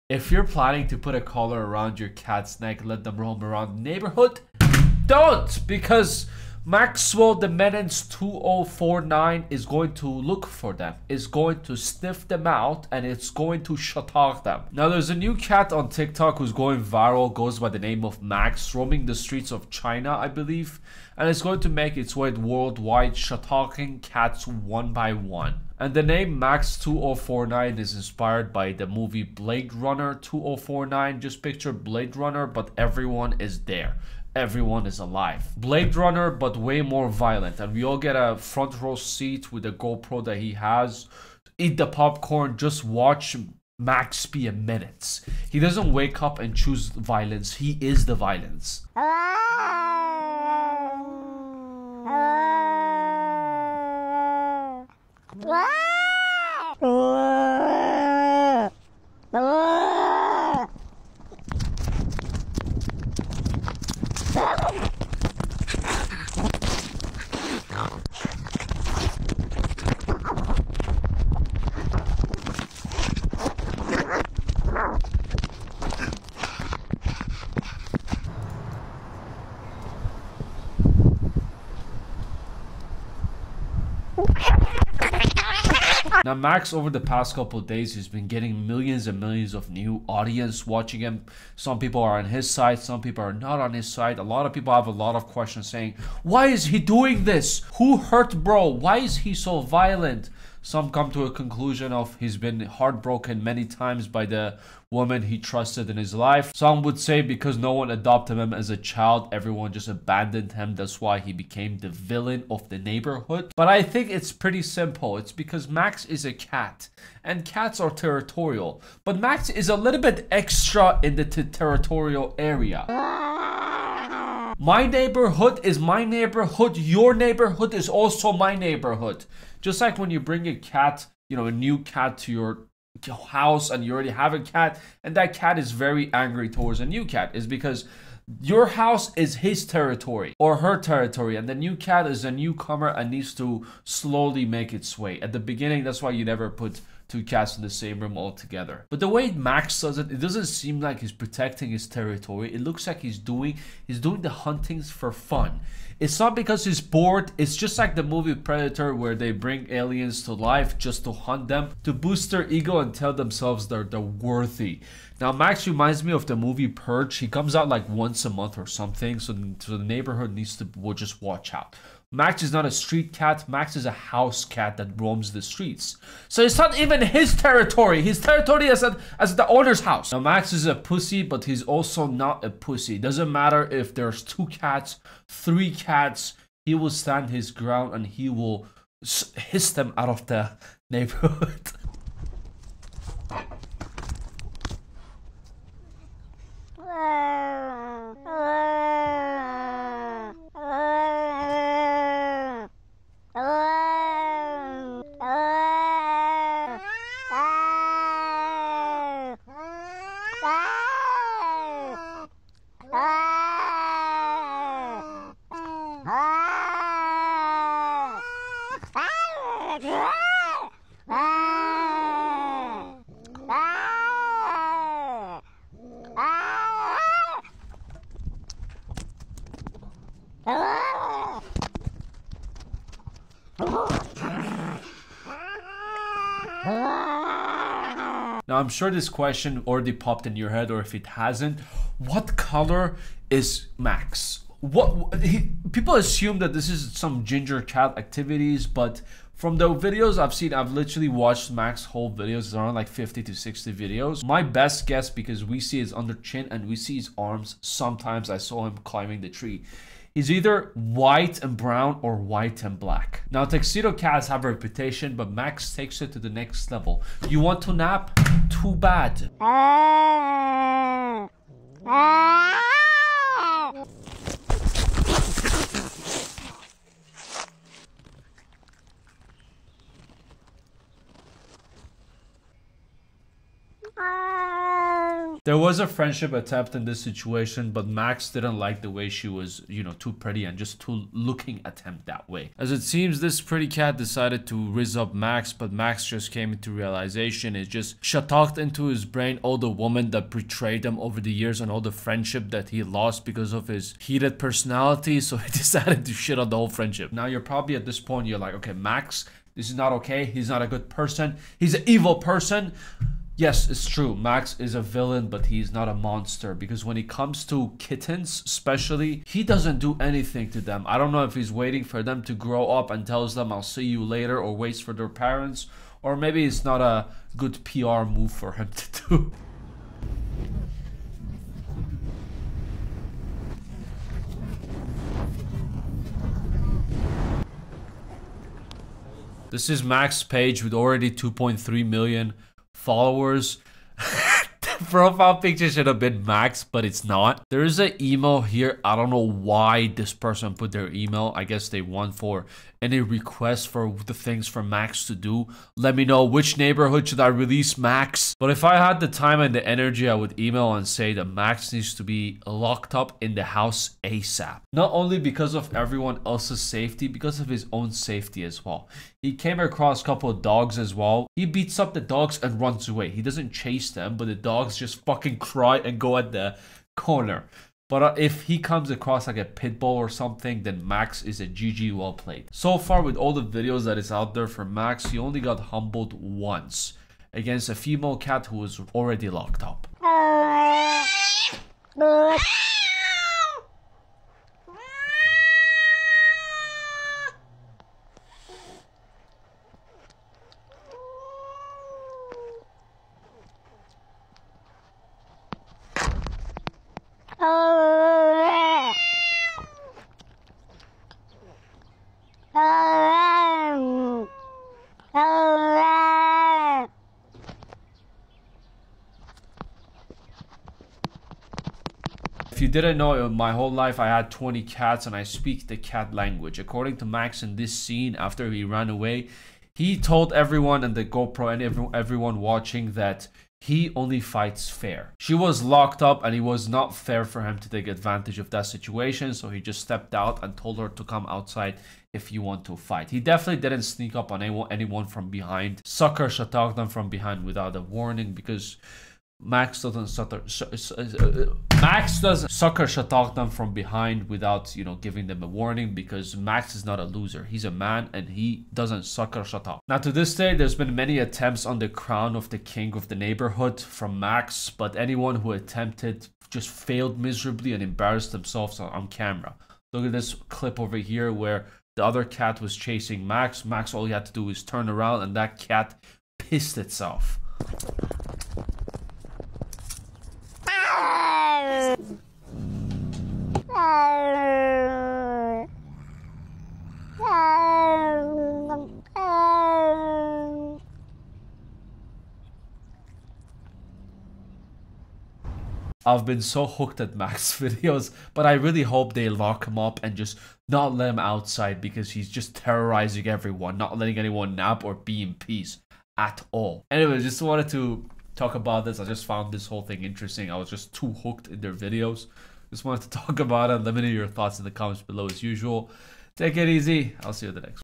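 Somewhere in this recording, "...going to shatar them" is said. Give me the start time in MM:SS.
00:13.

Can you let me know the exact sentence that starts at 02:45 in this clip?
Now Max reminds me of the movie Purge.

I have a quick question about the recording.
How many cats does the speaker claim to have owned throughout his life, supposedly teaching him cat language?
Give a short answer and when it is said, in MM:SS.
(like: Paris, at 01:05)
20, at 07:04.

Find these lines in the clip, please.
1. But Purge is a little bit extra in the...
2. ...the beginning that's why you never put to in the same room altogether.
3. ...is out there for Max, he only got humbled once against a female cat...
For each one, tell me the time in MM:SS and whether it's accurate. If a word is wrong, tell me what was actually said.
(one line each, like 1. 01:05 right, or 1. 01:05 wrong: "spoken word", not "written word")
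1. 01:59 wrong: "Max", not "Purge"
2. 02:25 right
3. 06:23 right.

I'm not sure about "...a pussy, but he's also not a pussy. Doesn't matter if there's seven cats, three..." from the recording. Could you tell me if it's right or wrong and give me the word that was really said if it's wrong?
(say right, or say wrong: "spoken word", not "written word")
wrong: "two", not "seven".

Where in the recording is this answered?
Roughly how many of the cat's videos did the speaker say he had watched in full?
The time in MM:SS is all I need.
04:12.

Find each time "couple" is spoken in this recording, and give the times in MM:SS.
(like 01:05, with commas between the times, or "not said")
01:27, 06:10.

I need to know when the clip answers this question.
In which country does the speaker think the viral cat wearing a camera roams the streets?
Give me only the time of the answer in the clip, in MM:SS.
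00:19.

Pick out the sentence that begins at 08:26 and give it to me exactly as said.
Anyway, just wanted to talk about this.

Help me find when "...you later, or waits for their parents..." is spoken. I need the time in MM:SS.
05:23.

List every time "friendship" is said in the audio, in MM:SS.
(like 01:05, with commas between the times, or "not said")
04:45, 05:01, 05:06.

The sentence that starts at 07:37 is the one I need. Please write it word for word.
He's a man and he doesn't sucker Shatak.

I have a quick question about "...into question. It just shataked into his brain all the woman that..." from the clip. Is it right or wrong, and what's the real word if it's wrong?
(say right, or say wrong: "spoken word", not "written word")
wrong: "realization", not "question".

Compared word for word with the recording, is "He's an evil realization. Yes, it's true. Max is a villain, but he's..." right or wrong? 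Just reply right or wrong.
wrong.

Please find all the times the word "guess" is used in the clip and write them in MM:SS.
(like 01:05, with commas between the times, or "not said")
04:14, 05:51.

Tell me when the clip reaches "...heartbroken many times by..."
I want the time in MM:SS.
01:42.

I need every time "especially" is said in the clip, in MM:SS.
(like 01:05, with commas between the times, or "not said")
05:18.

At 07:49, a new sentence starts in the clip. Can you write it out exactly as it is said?
Look at this clip over here where the other cat was chasing Max.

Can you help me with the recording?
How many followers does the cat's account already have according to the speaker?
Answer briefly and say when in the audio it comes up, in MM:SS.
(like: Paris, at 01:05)
2.3 million, at 05:41.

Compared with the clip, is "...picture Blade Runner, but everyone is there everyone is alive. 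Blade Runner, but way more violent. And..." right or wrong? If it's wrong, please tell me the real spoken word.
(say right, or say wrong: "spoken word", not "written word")
right.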